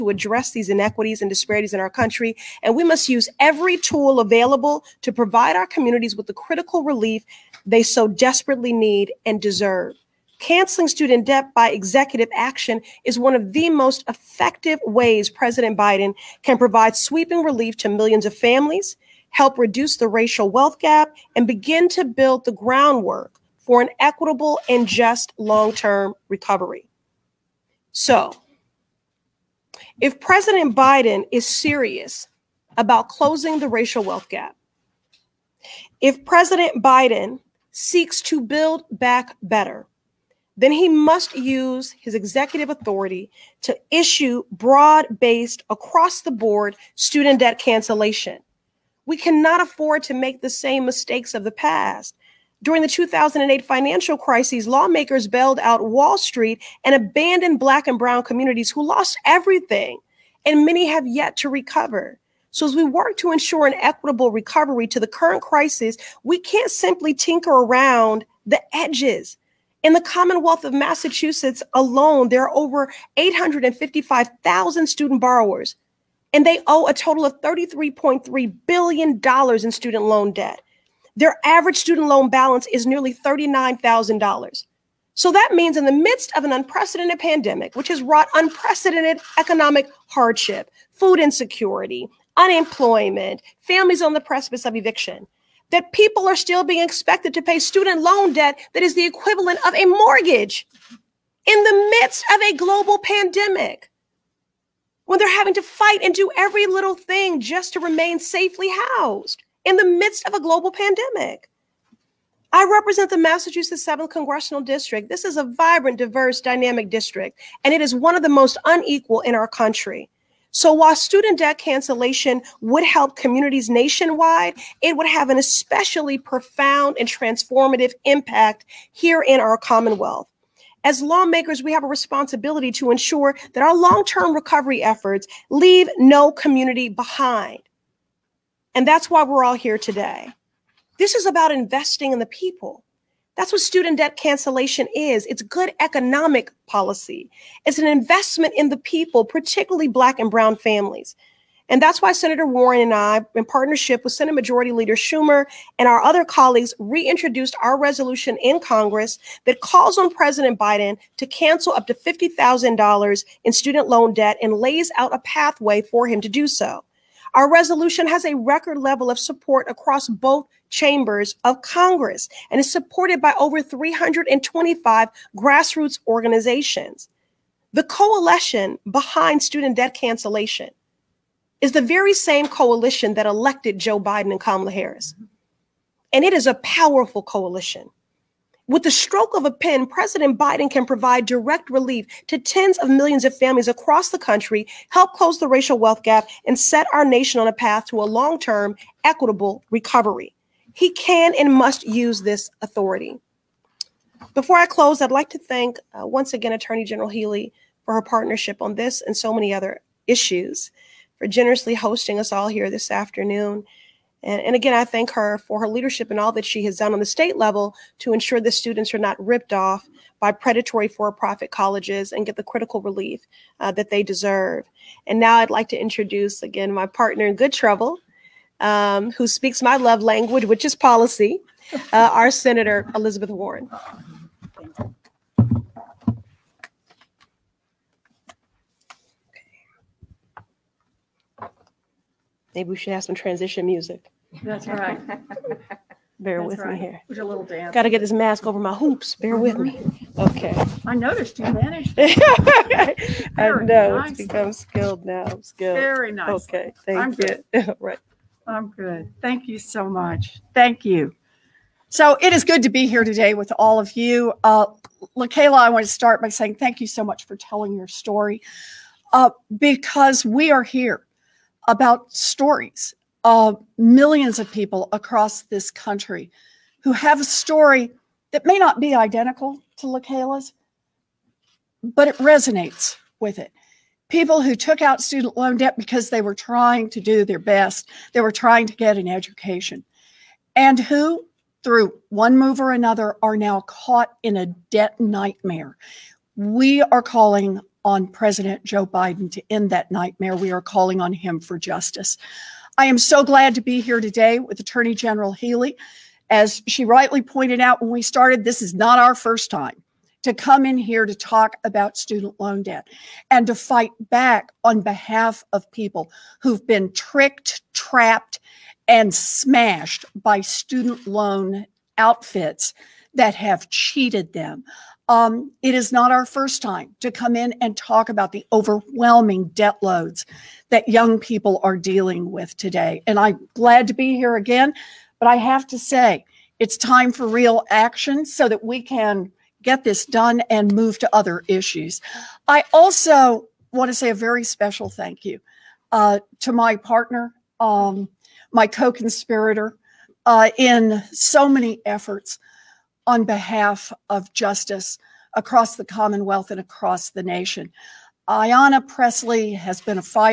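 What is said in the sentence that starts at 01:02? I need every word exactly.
So, as we work to ensure an equitable recovery to the current crisis, we can't simply tinker around the edges.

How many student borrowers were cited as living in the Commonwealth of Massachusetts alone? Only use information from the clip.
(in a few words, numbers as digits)
855,000.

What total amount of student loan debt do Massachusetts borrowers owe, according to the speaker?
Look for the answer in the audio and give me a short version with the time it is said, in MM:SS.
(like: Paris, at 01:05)
$33.3 billion, at 01:17.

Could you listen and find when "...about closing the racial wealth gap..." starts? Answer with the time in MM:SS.
00:32.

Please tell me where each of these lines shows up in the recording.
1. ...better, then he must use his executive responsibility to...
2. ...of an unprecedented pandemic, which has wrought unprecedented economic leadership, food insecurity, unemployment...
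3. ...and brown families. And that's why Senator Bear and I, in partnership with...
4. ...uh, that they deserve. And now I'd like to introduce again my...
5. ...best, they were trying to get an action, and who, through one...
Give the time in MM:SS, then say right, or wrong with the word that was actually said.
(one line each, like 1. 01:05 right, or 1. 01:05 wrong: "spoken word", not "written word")
1. 00:39 wrong: "authority", not "responsibility"
2. 01:26 wrong: "hardship", not "leadership"
3. 02:30 wrong: "Warren", not "Bear"
4. 03:43 right
5. 04:47 wrong: "education", not "action".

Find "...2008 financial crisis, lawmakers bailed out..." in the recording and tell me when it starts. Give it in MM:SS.
00:52.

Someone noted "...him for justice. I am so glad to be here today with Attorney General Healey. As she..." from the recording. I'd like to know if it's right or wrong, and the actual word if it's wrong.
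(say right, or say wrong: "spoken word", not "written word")
right.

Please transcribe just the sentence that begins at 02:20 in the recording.
This is about investing in the people.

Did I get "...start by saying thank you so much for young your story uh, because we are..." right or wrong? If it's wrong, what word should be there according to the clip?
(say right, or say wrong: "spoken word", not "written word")
wrong: "telling", not "young".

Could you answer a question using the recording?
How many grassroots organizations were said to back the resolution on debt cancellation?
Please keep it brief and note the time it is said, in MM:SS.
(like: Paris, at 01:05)
Over 325, at 02:53.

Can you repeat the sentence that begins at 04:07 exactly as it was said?
a little Got to get this mask over my hoops.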